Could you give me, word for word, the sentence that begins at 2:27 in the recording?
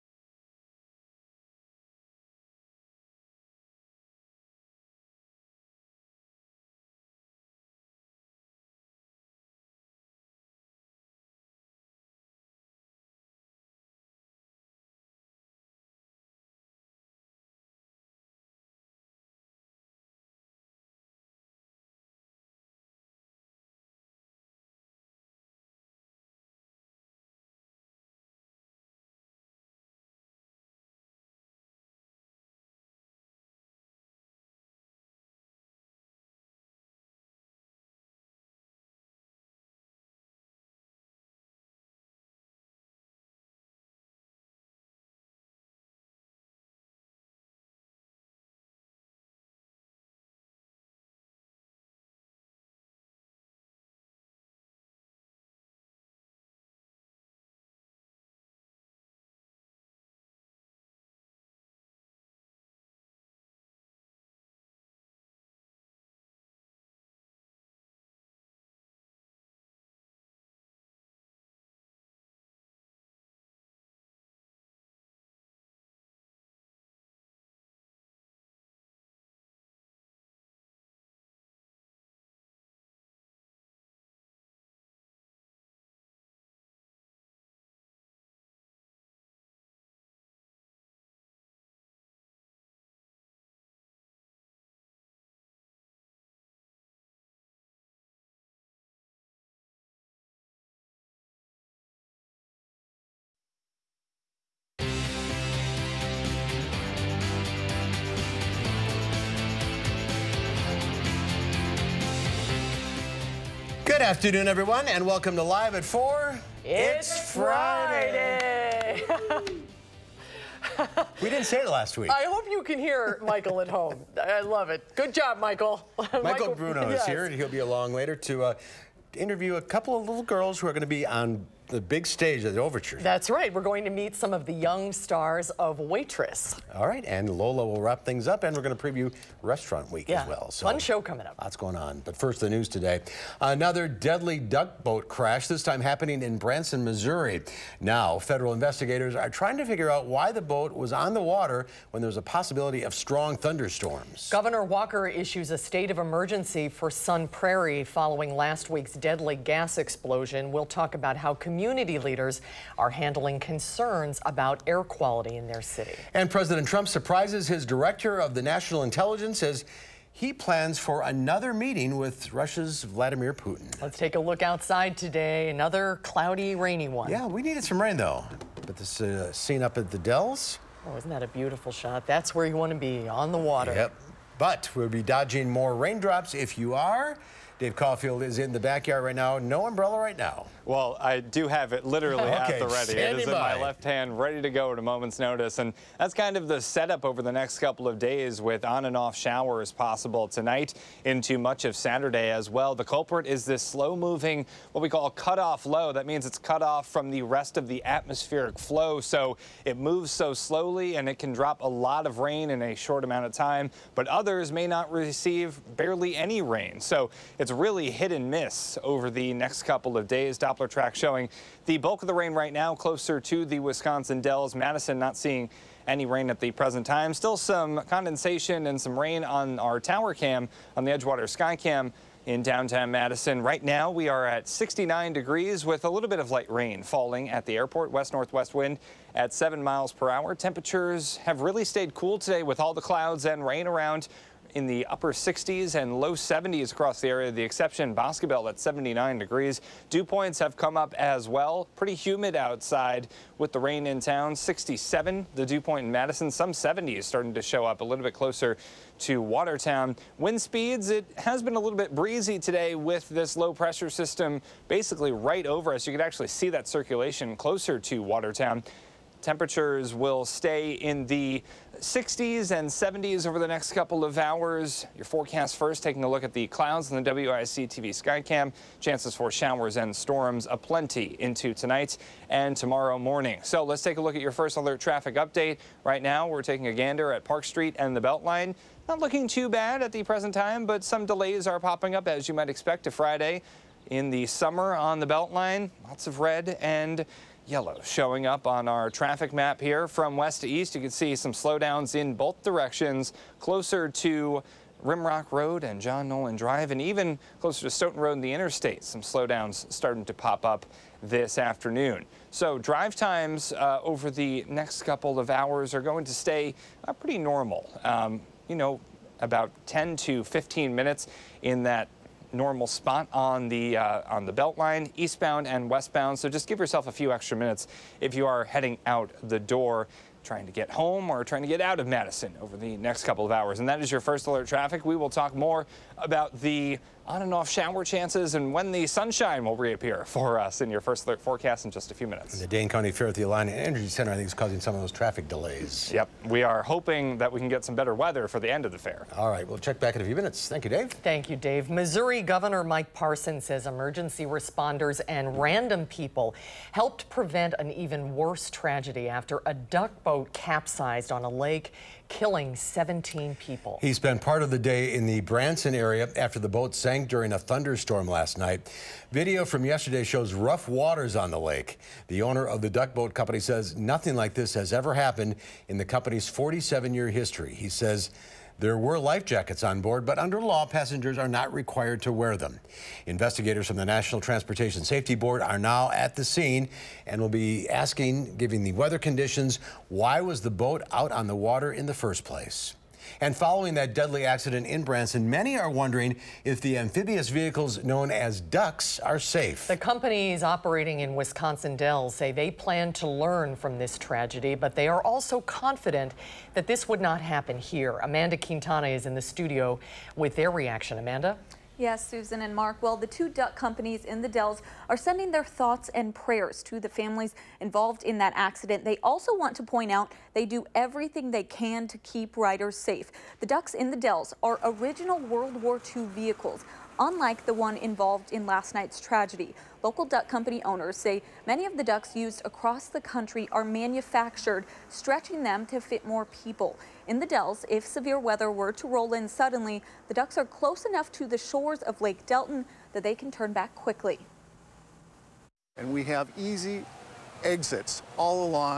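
Now, federal investigators are trying to figure out why the boat was on the water when there's a possibility of strong thunderstorms.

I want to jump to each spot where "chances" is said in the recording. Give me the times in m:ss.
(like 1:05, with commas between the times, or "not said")
4:38, 5:37.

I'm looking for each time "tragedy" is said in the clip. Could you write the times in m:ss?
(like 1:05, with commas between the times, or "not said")
5:58, 6:43, 7:08.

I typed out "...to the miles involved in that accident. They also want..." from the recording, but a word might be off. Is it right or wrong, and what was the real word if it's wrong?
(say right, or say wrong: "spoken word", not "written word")
wrong: "families", not "miles".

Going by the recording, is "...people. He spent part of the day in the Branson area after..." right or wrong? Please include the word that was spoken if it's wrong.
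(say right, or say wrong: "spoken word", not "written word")
right.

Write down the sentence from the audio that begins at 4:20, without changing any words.
Wind speeds, it has been a little bit breezy today with this low pressure system basically right over us.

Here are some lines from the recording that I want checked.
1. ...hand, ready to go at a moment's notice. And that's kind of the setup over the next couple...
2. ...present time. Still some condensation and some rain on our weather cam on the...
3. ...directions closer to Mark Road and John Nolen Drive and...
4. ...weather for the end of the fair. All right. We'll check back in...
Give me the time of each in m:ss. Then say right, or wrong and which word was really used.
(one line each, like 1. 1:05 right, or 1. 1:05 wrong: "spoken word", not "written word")
1. 3:13 right
2. 3:46 wrong: "tower", not "weather"
3. 5:02 wrong: "Rimrock", not "Mark"
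4. 5:47 right.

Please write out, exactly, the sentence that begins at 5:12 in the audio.
So drive times uh, over the next couple of hours are going to stay uh, pretty normal.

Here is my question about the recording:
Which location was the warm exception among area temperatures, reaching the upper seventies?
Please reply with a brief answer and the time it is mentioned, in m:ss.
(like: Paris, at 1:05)
Boscobel, at 4:07.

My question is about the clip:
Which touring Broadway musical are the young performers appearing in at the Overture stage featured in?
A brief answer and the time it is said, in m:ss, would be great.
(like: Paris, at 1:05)
Waitress, at 2:15.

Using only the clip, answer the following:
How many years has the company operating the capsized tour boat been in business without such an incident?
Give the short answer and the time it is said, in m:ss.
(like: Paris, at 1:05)
47, at 6:16.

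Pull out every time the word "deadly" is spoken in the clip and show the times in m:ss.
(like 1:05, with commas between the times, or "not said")
2:23, 2:38, 6:33.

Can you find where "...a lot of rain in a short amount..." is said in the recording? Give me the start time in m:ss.
3:31.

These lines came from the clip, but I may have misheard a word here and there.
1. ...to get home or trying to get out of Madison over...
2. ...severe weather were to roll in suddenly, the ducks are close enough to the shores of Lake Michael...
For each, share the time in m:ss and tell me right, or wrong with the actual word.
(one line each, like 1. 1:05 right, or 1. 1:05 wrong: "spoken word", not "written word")
1. 5:30 right
2. 7:17 wrong: "Delton", not "Michael".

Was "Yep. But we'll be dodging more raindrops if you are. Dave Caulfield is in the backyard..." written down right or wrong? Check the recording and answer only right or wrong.
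right.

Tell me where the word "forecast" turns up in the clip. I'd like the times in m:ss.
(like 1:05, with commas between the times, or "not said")
4:35, 5:41.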